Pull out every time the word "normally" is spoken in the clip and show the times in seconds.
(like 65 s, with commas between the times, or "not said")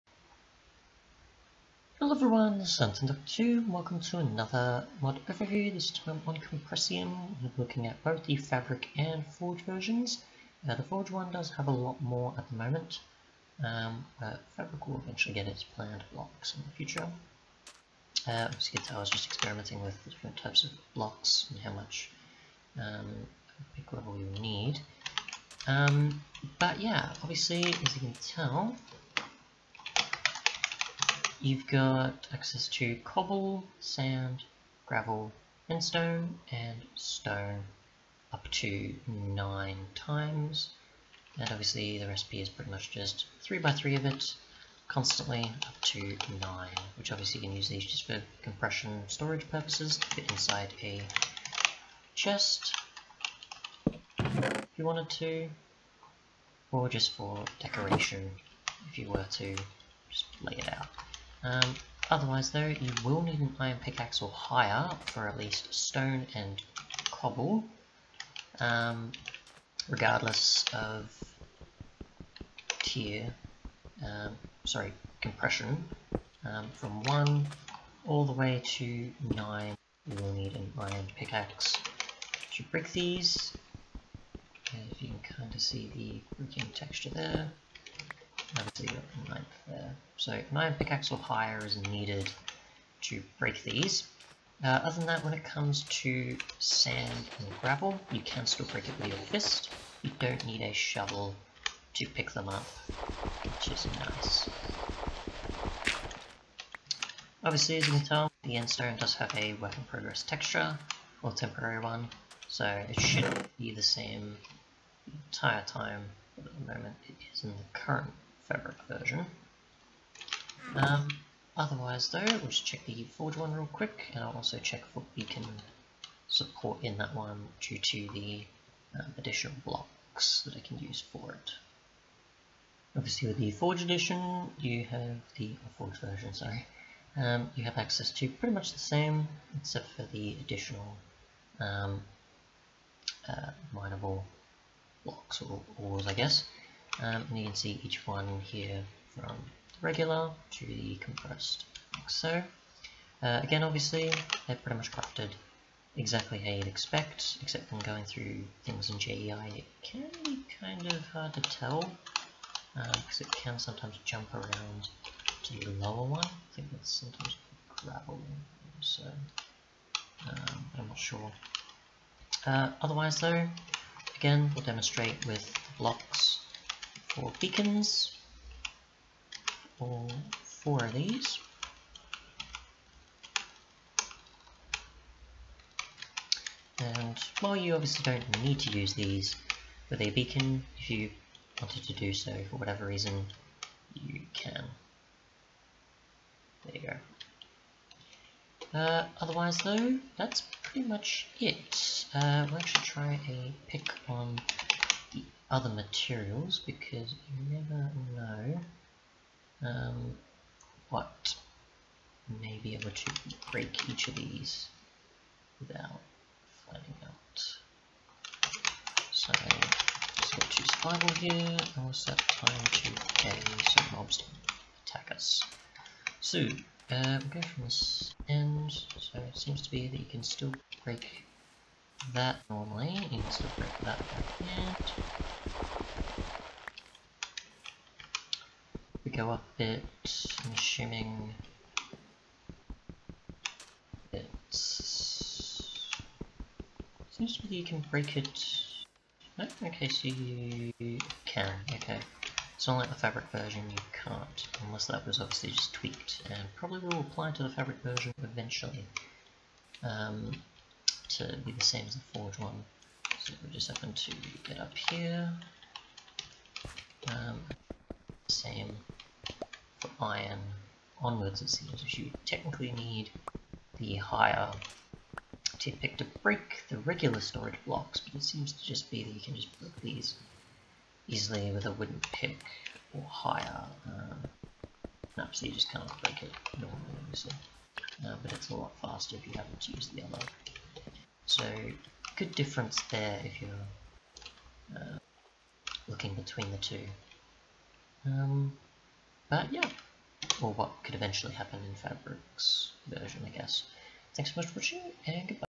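232 s, 286 s.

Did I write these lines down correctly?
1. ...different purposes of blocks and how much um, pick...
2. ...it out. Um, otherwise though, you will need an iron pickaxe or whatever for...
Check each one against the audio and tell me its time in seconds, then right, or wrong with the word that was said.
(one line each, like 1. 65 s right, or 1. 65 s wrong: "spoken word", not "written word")
1. 20 s wrong: "types", not "purposes"
2. 60 s wrong: "higher", not "whatever".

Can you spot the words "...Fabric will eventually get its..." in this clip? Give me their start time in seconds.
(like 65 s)
14 s.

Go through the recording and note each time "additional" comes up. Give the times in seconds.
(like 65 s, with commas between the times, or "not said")
129 s, 140 s.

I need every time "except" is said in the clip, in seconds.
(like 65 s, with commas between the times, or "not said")
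139 s, 157 s.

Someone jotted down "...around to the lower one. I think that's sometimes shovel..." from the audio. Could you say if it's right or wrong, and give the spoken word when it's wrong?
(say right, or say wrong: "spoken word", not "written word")
wrong: "gravel", not "shovel".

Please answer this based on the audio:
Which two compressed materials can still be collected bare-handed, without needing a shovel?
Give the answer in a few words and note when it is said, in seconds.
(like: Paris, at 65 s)
Sand and gravel, at 96 s.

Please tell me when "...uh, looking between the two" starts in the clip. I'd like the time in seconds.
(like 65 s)
294 s.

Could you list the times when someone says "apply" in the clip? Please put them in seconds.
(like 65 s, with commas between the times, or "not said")
256 s.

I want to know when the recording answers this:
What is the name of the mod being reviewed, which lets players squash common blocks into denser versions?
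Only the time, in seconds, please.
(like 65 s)
6 s.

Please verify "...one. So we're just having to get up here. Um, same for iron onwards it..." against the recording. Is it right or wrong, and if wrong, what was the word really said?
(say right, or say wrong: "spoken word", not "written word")
right.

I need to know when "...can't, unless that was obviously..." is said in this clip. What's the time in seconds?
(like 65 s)
253 s.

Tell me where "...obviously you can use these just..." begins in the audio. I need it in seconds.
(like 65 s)
47 s.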